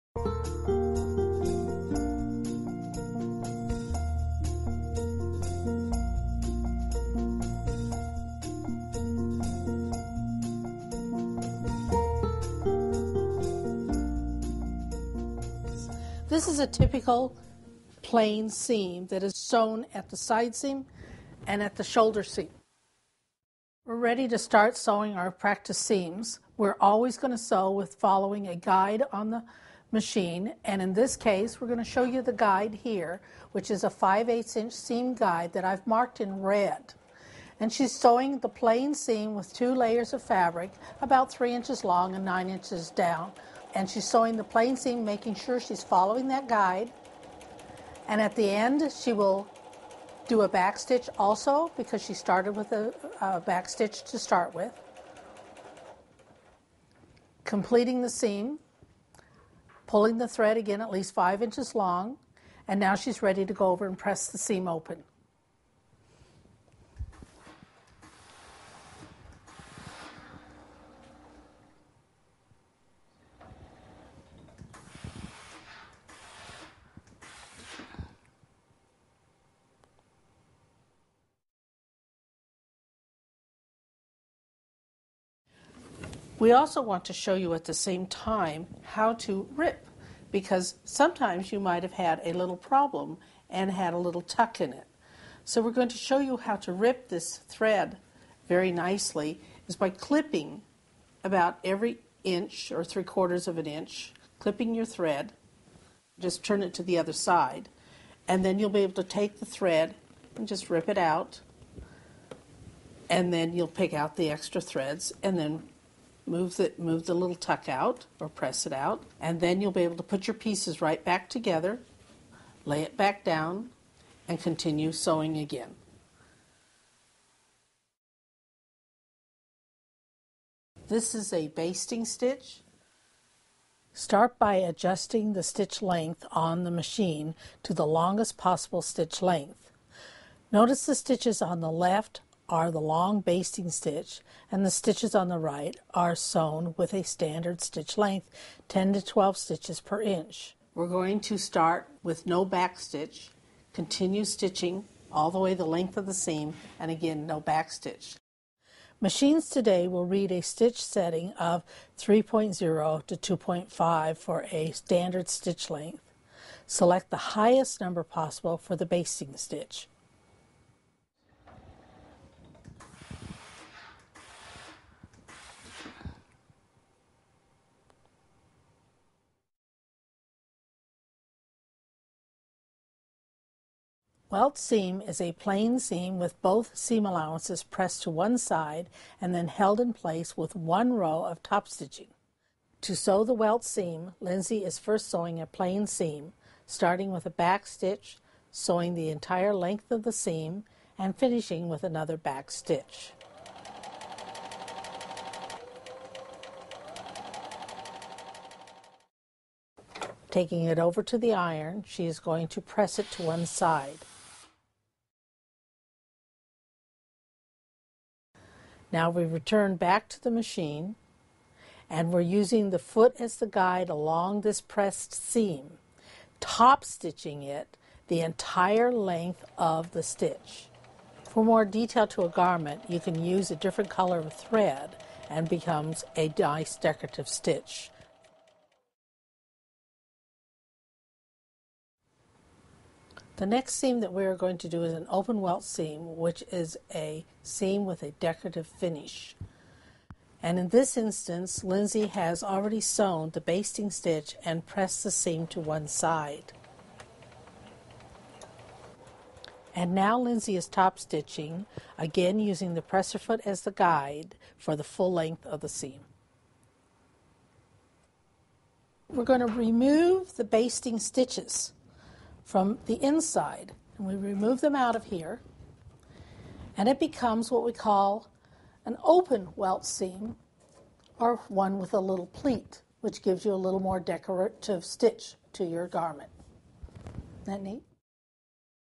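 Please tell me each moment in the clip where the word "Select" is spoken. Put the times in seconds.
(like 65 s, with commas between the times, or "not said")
166 s.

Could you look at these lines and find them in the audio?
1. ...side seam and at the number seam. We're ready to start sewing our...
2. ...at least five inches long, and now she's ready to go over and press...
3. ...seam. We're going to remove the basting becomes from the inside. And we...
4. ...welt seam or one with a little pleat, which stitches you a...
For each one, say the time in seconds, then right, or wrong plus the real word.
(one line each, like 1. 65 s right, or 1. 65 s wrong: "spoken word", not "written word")
1. 20 s wrong: "shoulder", not "number"
2. 60 s right
3. 265 s wrong: "stitches", not "becomes"
4. 279 s wrong: "gives", not "stitches".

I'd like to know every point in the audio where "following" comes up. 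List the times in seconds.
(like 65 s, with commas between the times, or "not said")
27 s, 45 s.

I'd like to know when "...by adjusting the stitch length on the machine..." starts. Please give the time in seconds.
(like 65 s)
134 s.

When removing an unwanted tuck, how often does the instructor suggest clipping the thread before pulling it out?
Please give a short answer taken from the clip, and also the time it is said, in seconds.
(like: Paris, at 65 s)
every inch, at 101 s.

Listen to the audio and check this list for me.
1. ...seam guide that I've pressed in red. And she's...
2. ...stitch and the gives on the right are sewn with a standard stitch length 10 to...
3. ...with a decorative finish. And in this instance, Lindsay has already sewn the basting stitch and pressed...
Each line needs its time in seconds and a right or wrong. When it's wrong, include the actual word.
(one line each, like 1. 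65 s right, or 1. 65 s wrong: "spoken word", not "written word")
1. 34 s wrong: "marked", not "pressed"
2. 143 s wrong: "stitches", not "gives"
3. 247 s right.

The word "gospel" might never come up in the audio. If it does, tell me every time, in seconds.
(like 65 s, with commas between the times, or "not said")
not said.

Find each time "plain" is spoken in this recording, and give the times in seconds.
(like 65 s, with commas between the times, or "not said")
18 s, 38 s, 44 s, 185 s, 195 s.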